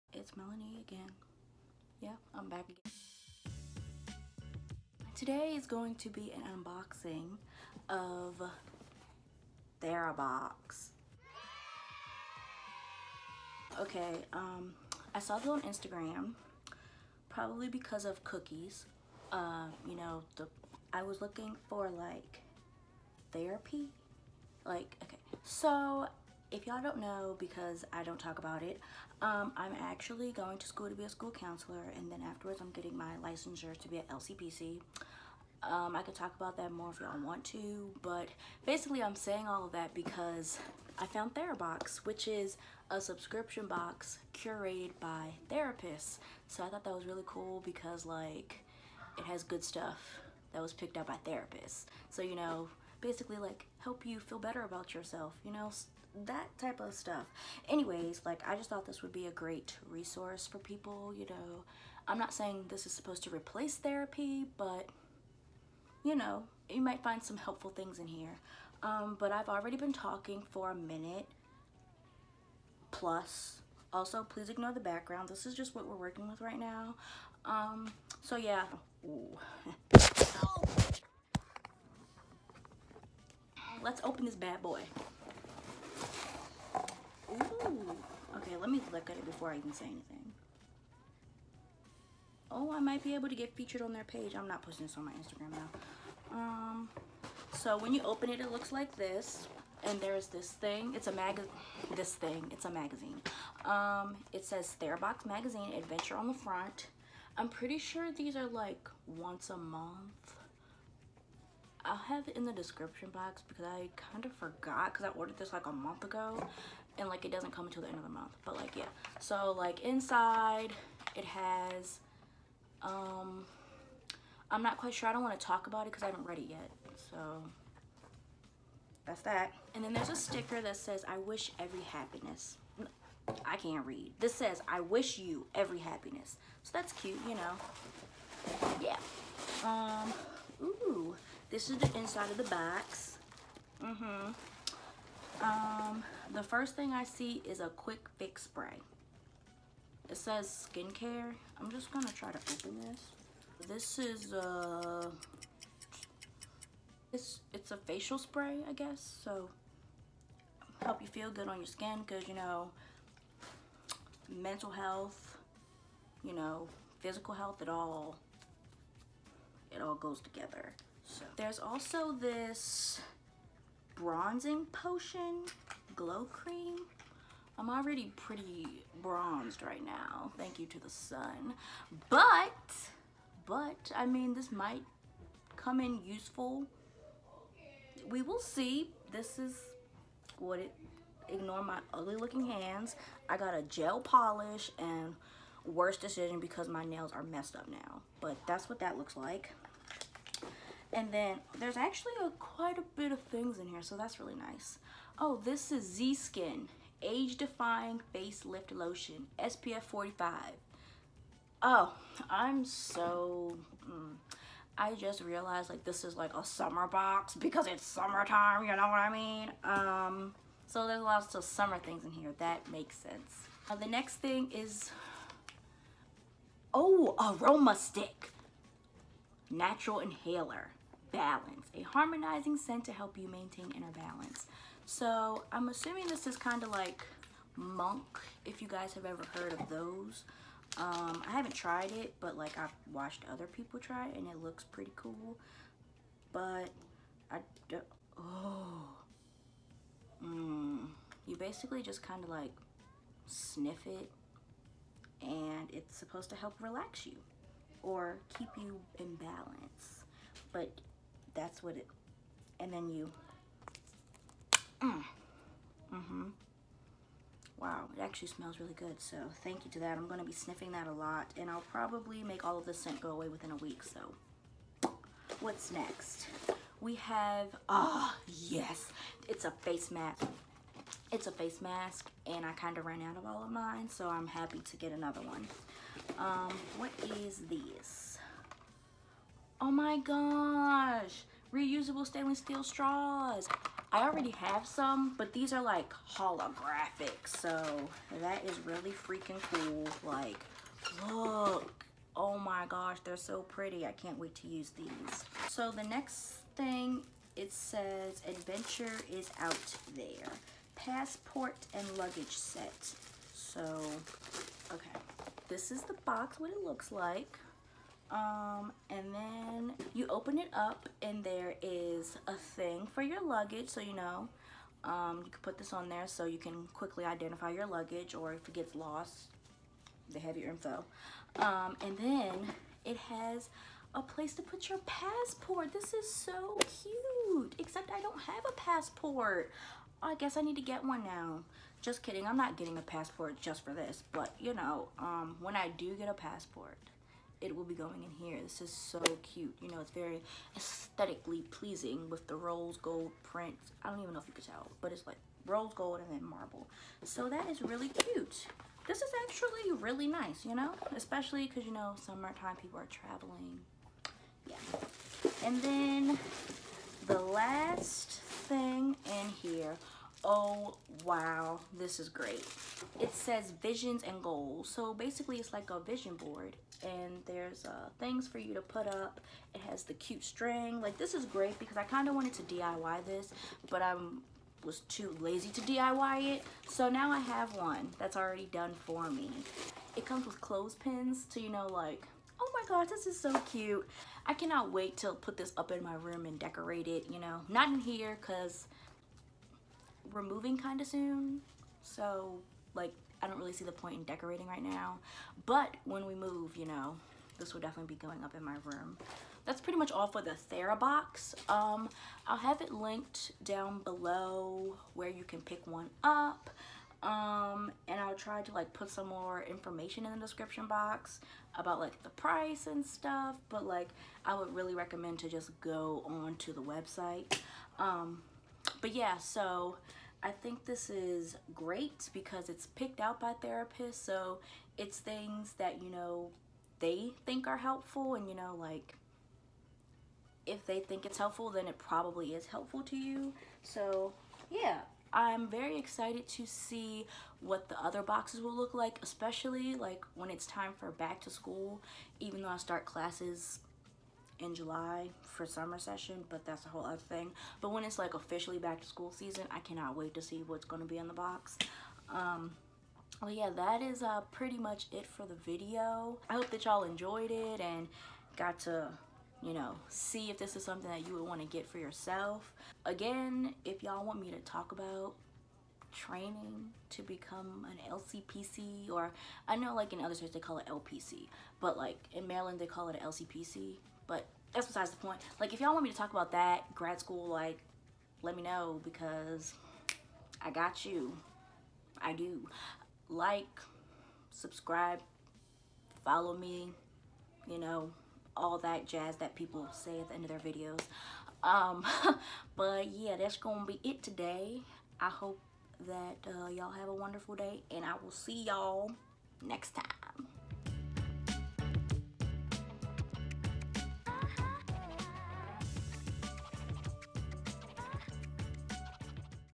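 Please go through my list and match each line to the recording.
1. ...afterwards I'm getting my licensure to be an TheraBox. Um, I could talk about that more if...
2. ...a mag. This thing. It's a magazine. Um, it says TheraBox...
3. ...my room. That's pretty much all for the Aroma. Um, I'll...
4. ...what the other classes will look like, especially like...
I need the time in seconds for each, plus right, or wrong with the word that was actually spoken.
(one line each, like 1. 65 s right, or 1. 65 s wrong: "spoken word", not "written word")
1. 32 s wrong: "LCPC", not "TheraBox"
2. 101 s right
3. 408 s wrong: "TheraBox", not "Aroma"
4. 447 s wrong: "boxes", not "classes".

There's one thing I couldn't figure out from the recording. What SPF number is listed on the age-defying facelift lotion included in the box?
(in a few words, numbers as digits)
45.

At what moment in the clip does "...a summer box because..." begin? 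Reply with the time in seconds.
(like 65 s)
216 s.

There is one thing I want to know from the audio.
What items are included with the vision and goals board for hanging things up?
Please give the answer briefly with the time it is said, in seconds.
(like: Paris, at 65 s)
Clothespins, at 390 s.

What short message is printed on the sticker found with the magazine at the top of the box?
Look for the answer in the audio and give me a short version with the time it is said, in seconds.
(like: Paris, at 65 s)
I wish you every happiness, at 134 s.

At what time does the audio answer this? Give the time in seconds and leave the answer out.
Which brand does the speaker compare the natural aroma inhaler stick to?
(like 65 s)
237 s.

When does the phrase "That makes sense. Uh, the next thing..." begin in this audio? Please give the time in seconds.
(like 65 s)
222 s.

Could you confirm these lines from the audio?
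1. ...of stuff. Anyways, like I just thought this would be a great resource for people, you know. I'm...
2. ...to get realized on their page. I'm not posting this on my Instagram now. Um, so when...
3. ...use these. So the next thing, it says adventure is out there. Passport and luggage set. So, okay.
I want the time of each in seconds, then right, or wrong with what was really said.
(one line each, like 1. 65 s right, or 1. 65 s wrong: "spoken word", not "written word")
1. 56 s right
2. 93 s wrong: "featured", not "realized"
3. 304 s right.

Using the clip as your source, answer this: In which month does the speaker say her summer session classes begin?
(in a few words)
July.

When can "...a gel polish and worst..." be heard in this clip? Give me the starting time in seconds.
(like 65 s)
193 s.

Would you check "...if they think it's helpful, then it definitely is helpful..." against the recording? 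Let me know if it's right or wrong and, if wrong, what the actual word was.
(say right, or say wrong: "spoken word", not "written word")
wrong: "probably", not "definitely".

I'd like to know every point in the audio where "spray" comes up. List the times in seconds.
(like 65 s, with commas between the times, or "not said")
148 s, 158 s.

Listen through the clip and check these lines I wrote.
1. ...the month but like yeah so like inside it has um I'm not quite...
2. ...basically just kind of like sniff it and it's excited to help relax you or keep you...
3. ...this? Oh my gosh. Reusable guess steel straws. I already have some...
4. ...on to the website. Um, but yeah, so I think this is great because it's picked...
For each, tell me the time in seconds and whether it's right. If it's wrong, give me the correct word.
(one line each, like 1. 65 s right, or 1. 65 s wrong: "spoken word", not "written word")
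1. 118 s right
2. 251 s wrong: "supposed", not "excited"
3. 287 s wrong: "stainless", not "guess"
4. 426 s right.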